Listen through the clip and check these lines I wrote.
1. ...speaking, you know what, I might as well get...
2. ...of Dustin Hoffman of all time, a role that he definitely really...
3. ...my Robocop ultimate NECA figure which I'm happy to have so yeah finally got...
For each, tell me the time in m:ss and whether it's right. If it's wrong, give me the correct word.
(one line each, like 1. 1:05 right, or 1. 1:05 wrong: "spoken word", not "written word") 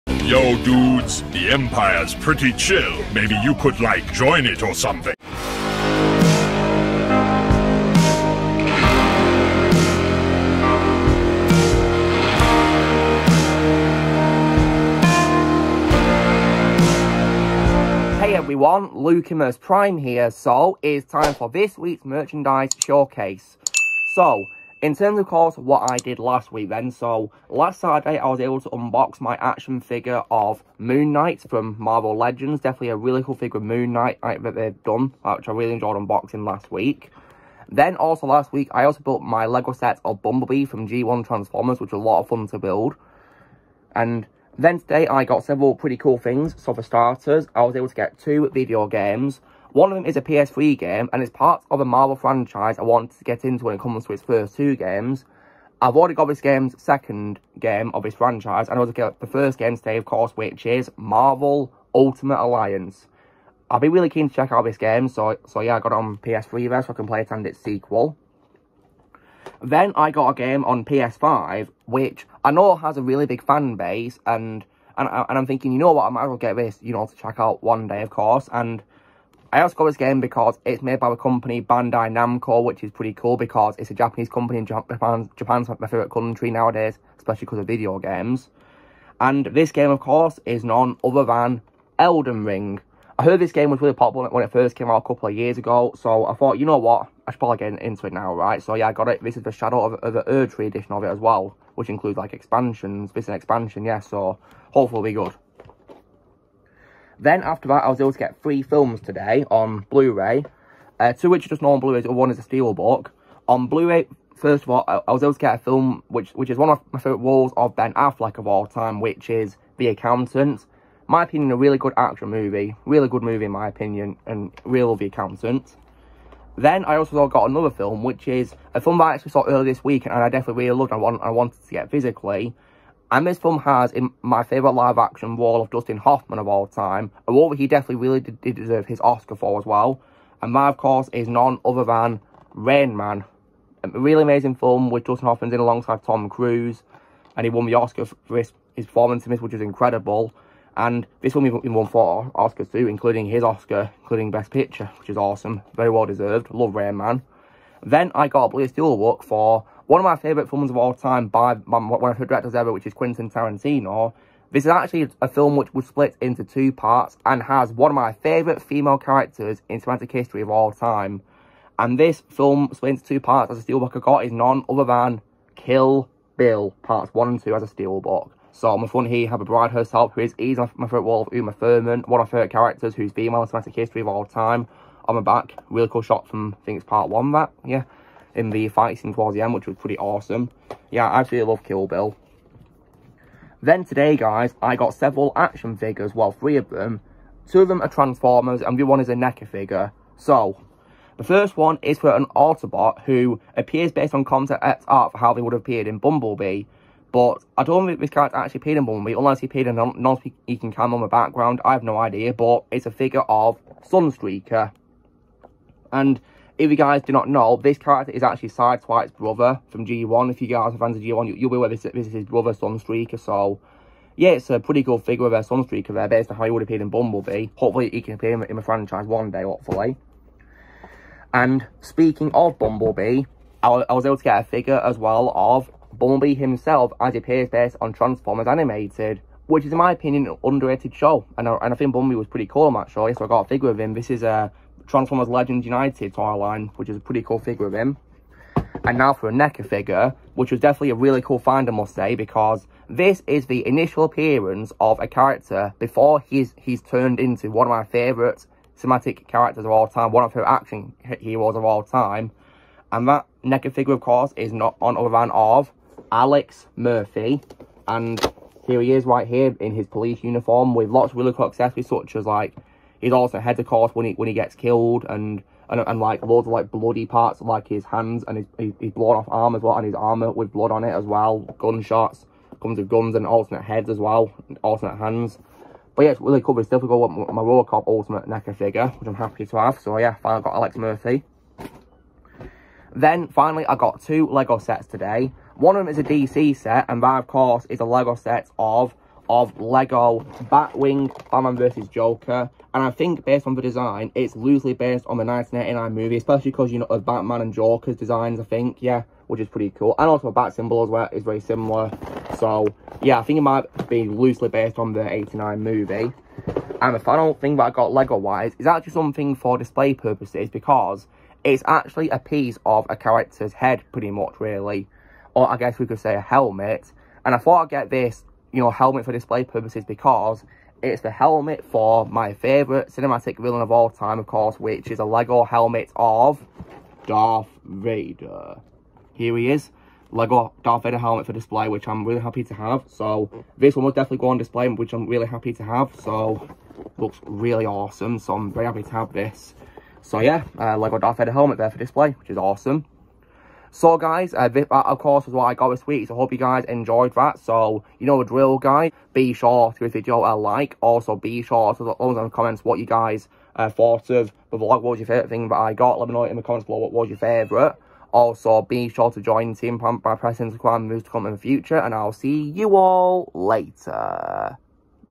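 1. 1:15 wrong: "thinking", not "speaking"
2. 2:15 right
3. 4:47 right.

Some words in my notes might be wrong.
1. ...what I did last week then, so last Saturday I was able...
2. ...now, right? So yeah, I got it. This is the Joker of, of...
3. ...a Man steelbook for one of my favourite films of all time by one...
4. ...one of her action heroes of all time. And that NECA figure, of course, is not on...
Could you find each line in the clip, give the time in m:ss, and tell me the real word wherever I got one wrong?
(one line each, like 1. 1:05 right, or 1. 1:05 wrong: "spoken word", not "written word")
1. 0:25 right
2. 1:38 wrong: "Shadow", not "Joker"
3. 2:38 wrong: "Blue", not "Man"
4. 4:20 right.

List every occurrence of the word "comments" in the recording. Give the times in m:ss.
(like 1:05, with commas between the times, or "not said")
6:02, 6:06.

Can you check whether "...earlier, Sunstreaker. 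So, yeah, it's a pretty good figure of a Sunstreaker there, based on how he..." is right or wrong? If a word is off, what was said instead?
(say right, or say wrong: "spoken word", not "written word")
wrong: "brother", not "earlier".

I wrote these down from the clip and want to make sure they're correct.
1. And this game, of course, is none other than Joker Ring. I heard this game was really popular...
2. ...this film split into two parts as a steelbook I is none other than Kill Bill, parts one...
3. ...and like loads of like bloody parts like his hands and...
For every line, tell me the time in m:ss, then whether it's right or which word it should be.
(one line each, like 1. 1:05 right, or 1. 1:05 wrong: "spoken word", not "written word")
1. 1:29 wrong: "Elden", not "Joker"
2. 2:51 right
3. 4:35 right.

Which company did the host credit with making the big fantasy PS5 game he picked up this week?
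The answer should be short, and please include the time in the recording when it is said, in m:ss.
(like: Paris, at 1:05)
Bandai Namco, at 1:21.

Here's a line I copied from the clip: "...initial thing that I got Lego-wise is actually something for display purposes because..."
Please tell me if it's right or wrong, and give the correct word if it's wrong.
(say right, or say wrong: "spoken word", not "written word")
wrong: "final", not "initial".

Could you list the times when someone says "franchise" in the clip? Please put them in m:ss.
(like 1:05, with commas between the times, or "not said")
0:52, 0:58, 3:48.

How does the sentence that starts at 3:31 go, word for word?
I have no idea, but it's a figure of Sunstreaker.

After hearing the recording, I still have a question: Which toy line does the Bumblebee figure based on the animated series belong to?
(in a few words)
Transformers Legends United.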